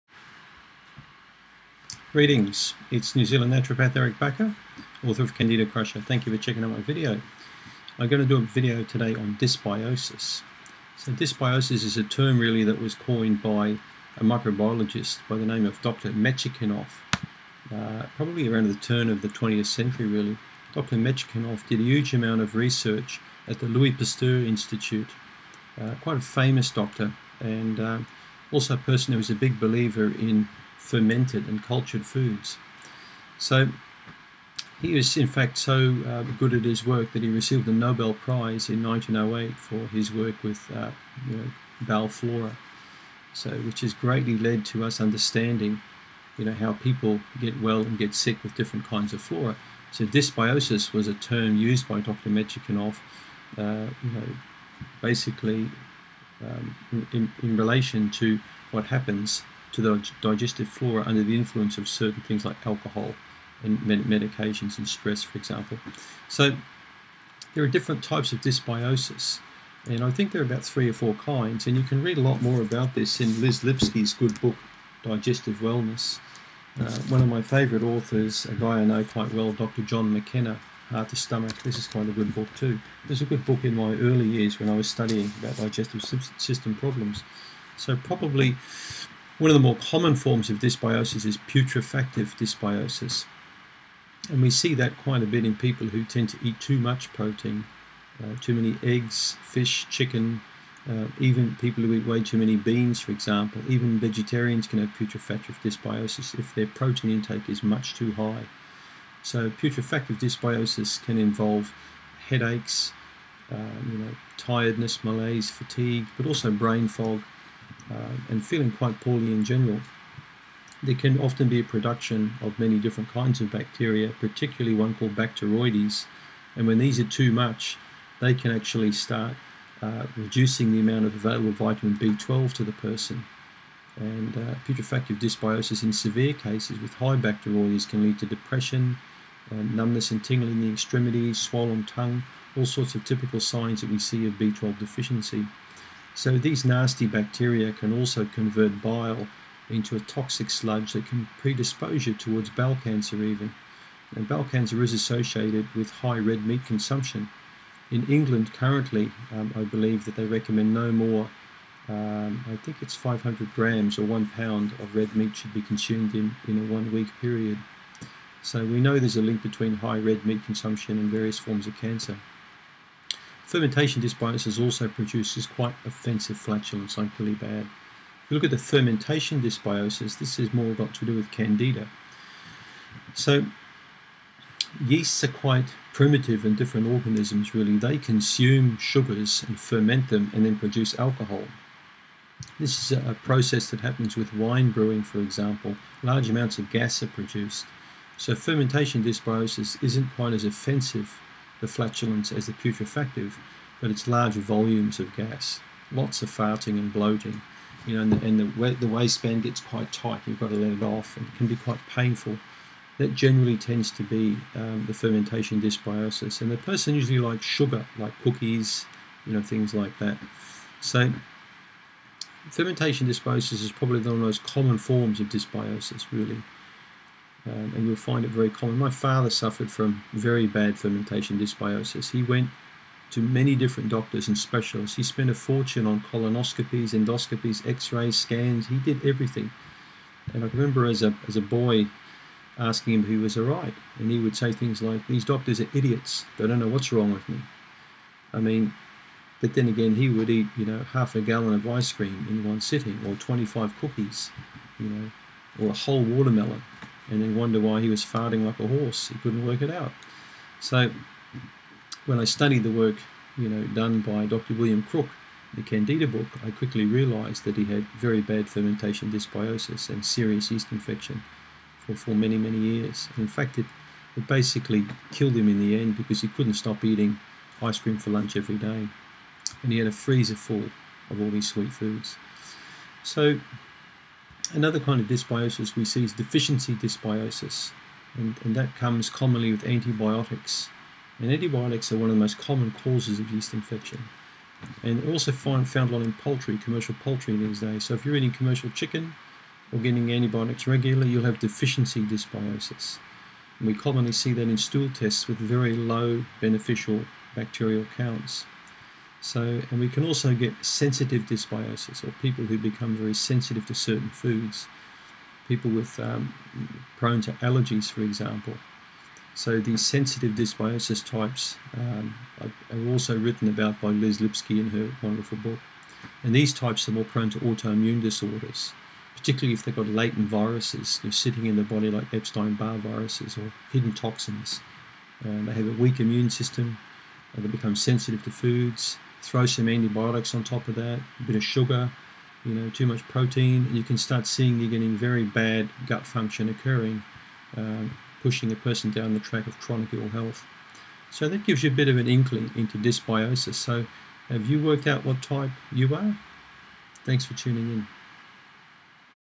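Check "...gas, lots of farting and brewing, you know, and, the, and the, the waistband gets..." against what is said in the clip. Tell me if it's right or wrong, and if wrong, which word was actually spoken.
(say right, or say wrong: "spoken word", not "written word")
wrong: "bloating", not "brewing".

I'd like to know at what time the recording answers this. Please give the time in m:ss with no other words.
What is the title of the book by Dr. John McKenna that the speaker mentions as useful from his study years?
1:20.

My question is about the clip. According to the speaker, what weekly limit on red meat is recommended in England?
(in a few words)
500 grams.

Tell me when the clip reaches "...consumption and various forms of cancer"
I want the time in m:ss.
2:50.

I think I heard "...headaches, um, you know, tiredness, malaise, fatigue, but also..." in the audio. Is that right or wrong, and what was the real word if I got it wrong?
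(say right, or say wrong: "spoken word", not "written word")
right.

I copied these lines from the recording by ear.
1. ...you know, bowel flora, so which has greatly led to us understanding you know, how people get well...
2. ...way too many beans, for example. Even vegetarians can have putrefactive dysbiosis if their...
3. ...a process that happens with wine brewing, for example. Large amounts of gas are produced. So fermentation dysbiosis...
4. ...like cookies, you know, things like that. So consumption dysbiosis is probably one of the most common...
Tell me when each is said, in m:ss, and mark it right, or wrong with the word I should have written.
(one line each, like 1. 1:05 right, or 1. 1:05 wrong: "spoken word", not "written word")
1. 0:41 right
2. 1:42 right
3. 3:13 right
4. 3:37 wrong: "fermentation", not "consumption".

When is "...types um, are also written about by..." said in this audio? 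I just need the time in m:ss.
5:21.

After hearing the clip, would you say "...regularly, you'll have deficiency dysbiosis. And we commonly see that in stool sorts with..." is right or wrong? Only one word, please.
wrong.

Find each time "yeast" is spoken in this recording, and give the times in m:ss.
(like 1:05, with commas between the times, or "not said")
3:04, 4:30, 4:53.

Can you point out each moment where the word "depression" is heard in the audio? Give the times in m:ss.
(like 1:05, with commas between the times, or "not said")
2:18.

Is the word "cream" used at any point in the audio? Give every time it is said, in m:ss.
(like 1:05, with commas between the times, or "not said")
4:11, 4:37.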